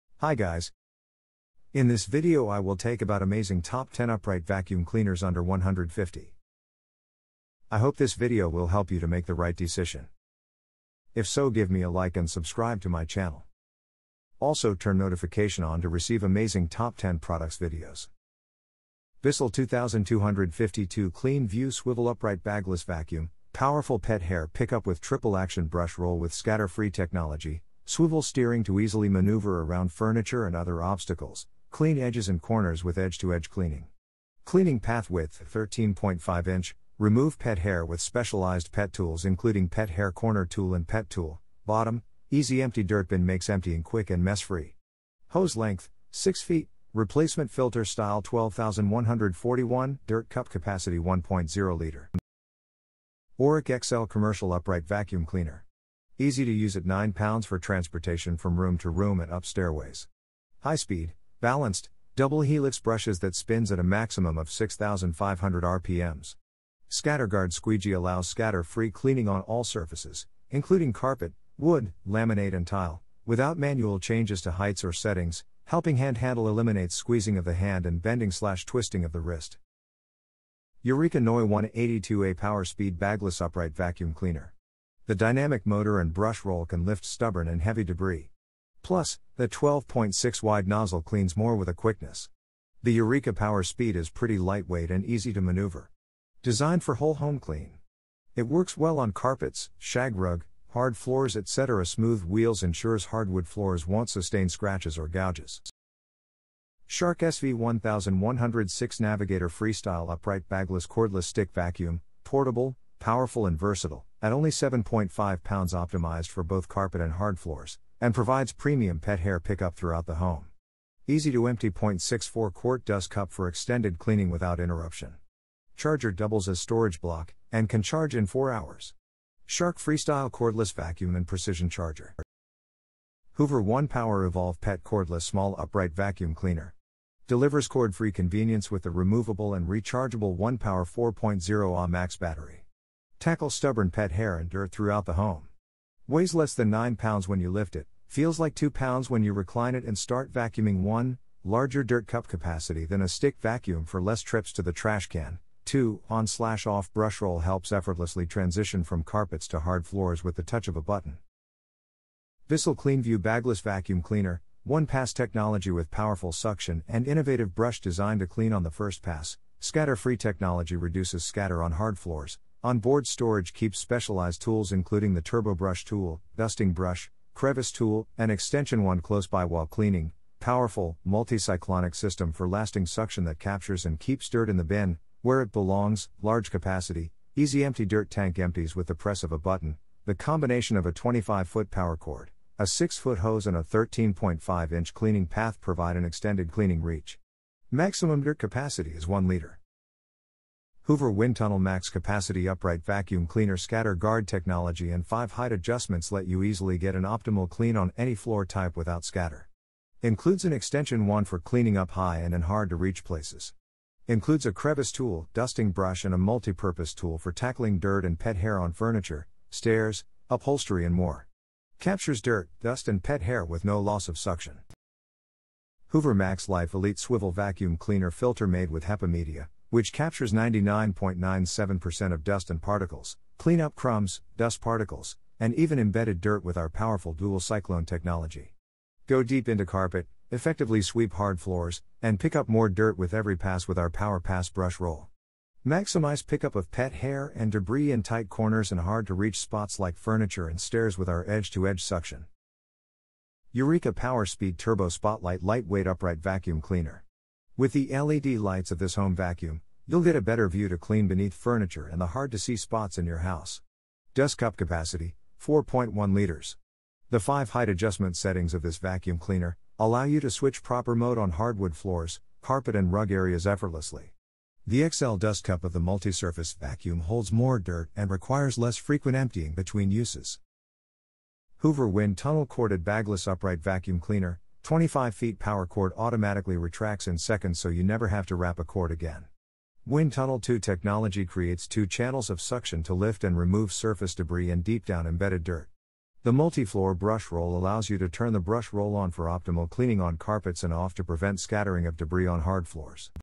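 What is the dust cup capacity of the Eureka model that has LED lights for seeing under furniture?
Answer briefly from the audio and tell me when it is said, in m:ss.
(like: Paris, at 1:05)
4.1 liters, at 4:25.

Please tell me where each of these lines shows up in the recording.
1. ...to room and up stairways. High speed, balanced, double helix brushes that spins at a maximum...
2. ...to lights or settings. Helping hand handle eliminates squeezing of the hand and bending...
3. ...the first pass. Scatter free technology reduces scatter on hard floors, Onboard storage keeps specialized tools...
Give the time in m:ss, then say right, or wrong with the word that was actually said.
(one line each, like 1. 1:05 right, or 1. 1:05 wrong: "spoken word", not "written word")
1. 0:58 right
2. 1:14 wrong: "heights", not "lights"
3. 2:48 right.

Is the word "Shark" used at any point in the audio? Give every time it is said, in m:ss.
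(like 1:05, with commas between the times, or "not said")
1:46, 2:09.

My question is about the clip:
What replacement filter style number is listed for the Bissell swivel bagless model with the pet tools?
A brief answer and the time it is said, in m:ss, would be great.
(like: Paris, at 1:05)
12141, at 0:48.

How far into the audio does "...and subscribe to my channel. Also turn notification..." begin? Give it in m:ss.
0:12.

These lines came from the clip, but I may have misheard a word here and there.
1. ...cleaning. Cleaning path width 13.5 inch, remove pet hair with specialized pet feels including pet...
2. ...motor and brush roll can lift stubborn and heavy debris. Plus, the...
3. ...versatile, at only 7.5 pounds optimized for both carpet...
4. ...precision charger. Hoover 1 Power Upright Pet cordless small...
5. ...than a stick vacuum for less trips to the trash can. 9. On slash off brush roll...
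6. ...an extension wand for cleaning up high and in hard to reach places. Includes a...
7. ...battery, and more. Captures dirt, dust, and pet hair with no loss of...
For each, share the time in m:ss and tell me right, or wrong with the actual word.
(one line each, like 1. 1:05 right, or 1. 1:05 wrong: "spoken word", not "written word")
1. 0:33 wrong: "tools", not "feels"
2. 1:25 right
3. 1:53 right
4. 2:11 wrong: "Evolve", not "Upright"
5. 2:32 wrong: "2", not "9"
6. 3:30 right
7. 3:40 wrong: "upholstery", not "battery".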